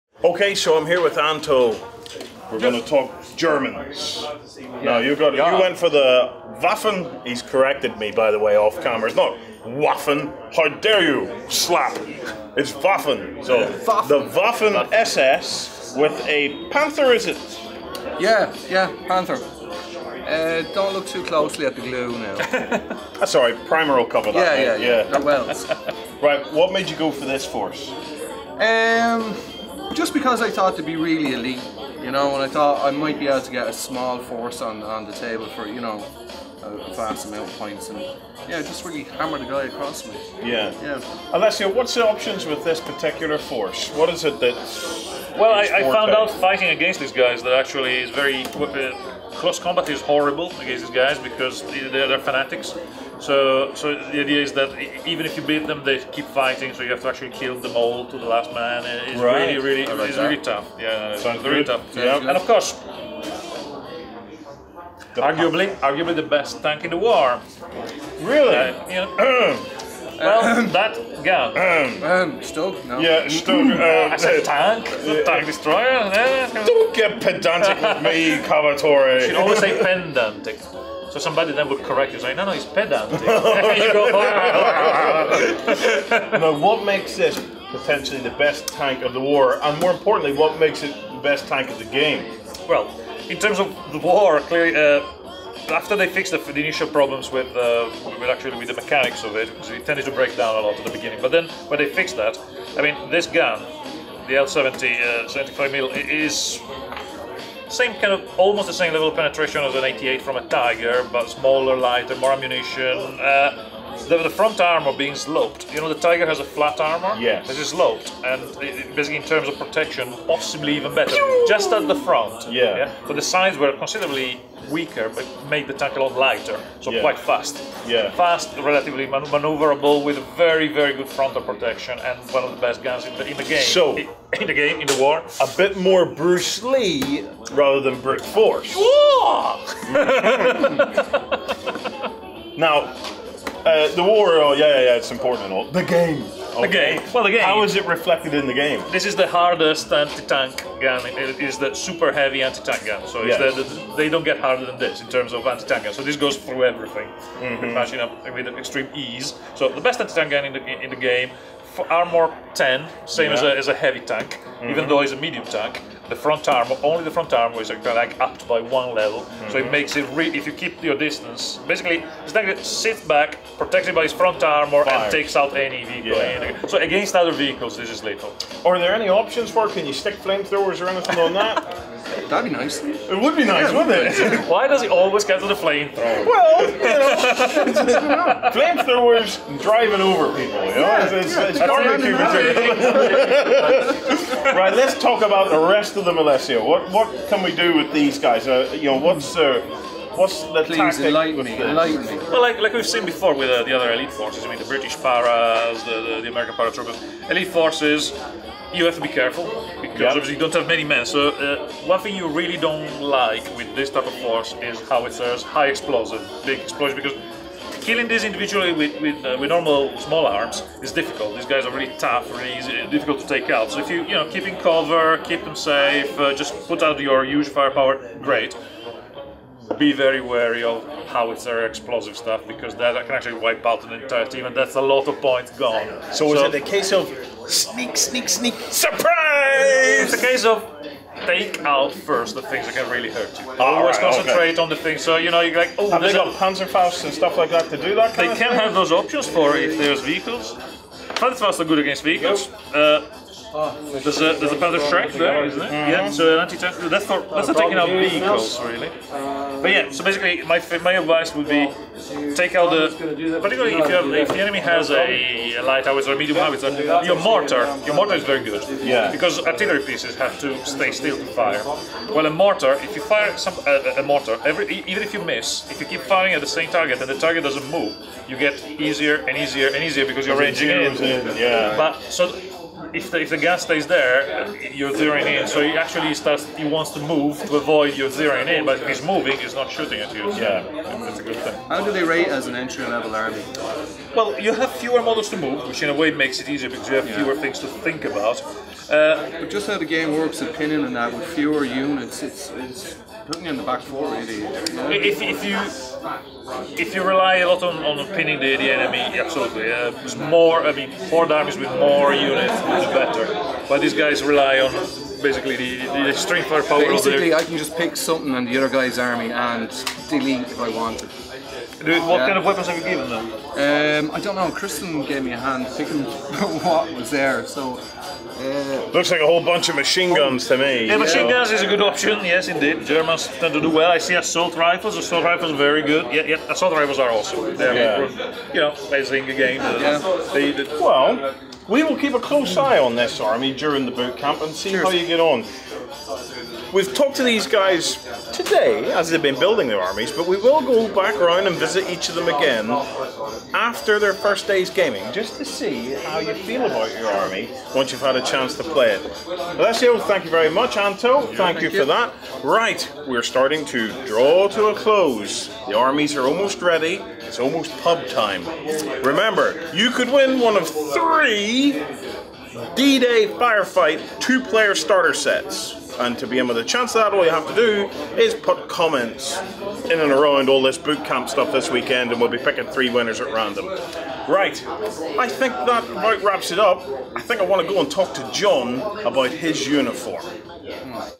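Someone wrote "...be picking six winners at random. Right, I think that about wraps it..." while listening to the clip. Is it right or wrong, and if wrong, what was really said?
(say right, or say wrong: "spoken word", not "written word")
wrong: "three", not "six".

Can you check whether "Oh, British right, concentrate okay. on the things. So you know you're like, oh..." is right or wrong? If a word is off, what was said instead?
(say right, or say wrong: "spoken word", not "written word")
wrong: "Always", not "British".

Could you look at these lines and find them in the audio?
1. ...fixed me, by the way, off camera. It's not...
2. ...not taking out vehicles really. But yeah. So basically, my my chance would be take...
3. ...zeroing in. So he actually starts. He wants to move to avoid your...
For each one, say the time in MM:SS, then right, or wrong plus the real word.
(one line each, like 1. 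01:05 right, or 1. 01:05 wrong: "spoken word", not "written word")
1. 00:07 wrong: "corrected", not "fixed"
2. 04:17 wrong: "advice", not "chance"
3. 04:44 right.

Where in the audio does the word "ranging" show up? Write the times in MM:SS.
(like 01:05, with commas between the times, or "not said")
04:40.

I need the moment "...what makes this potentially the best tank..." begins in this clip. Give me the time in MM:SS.
01:26.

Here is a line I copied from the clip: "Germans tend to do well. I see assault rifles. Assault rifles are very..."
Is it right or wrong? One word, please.
right.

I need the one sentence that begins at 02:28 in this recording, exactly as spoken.
This is the hardest anti-tank gun.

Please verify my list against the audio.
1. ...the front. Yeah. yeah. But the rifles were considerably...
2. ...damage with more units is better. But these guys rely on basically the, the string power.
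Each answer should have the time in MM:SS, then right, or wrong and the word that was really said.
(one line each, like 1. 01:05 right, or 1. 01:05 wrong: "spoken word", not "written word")
1. 02:01 wrong: "sides", not "rifles"
2. 05:11 right.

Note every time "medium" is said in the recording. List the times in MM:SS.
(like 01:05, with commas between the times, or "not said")
02:45, 04:26.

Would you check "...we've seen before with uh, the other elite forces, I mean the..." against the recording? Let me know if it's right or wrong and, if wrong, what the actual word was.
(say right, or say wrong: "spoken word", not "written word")
right.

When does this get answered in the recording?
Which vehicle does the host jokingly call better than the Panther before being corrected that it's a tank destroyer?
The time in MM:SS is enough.
01:13.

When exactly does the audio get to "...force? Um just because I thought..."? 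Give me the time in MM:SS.
00:27.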